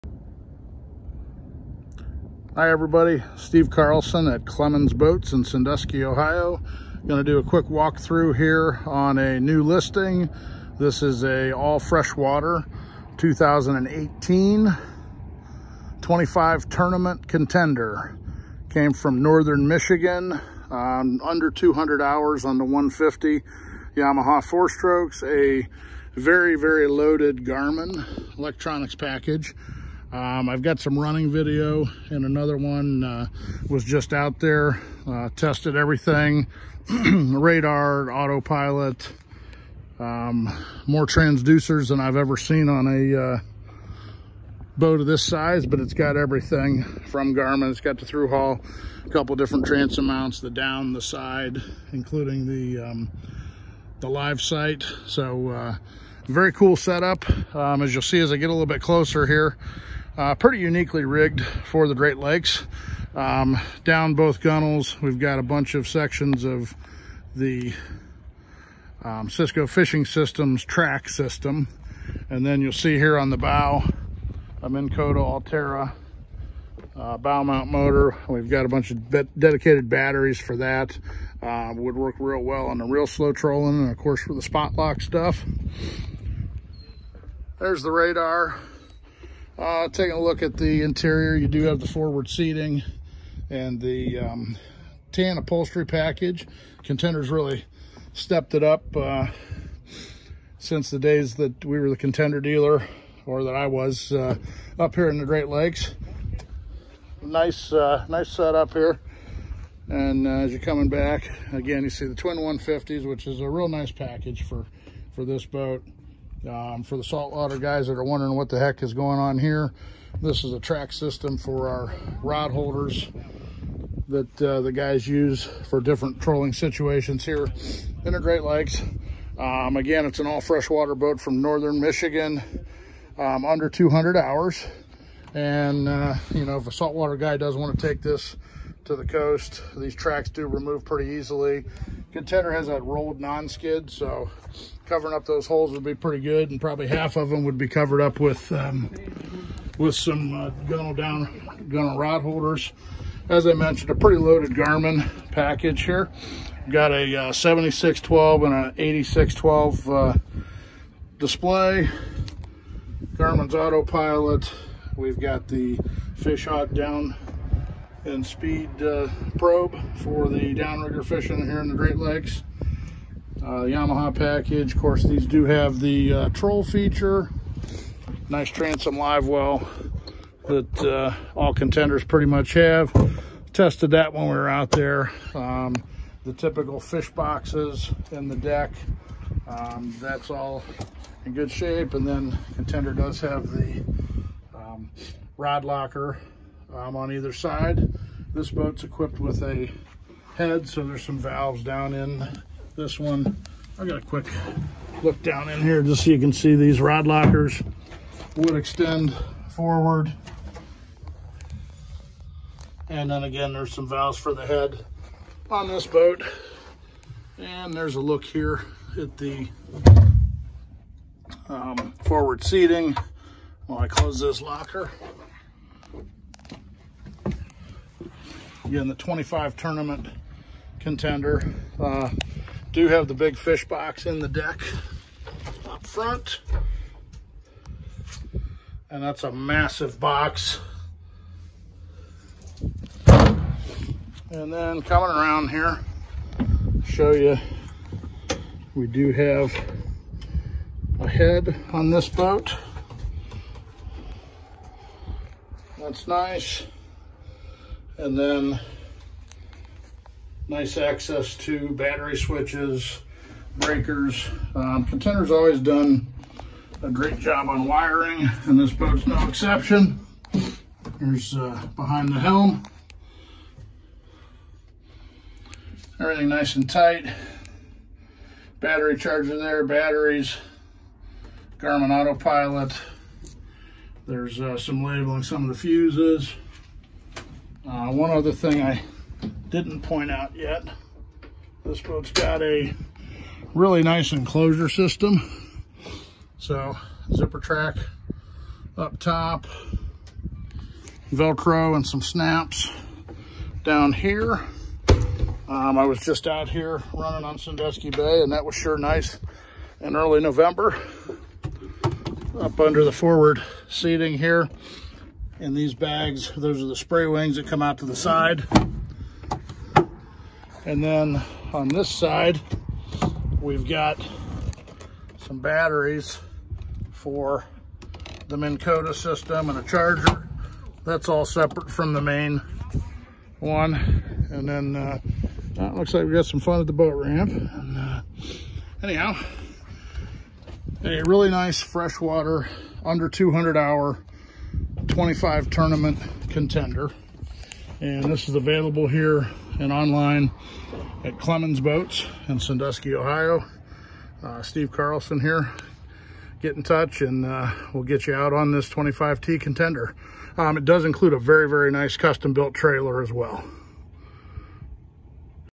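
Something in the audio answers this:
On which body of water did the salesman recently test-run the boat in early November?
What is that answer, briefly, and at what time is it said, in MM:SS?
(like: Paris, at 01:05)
Sandusky Bay, at 05:07.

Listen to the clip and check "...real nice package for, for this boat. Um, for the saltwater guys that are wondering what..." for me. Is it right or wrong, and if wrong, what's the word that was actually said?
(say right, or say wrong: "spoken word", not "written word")
right.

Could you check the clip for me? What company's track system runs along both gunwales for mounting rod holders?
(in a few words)
Cisco Fishing Systems.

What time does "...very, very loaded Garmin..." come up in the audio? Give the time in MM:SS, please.
00:26.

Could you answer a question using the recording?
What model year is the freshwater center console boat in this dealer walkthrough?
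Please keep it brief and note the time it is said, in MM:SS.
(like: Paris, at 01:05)
2018, at 00:13.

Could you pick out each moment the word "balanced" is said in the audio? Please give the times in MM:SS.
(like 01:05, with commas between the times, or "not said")
not said.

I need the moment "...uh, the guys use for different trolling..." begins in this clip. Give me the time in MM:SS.
02:04.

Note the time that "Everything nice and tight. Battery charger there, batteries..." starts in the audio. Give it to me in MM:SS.
04:35.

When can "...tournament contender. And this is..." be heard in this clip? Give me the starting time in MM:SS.
05:45.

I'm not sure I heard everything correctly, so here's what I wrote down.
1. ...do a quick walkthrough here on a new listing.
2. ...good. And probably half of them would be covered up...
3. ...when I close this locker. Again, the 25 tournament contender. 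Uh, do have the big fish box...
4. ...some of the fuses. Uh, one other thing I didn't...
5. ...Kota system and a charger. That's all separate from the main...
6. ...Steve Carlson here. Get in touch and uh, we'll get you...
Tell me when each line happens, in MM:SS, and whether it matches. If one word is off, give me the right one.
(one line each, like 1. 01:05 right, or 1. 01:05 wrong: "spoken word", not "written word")
1. 00:07 right
2. 02:26 right
3. 03:43 right
4. 04:45 right
5. 05:28 right
6. 05:54 right.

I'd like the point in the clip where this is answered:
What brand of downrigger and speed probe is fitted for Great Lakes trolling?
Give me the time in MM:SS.
02:46.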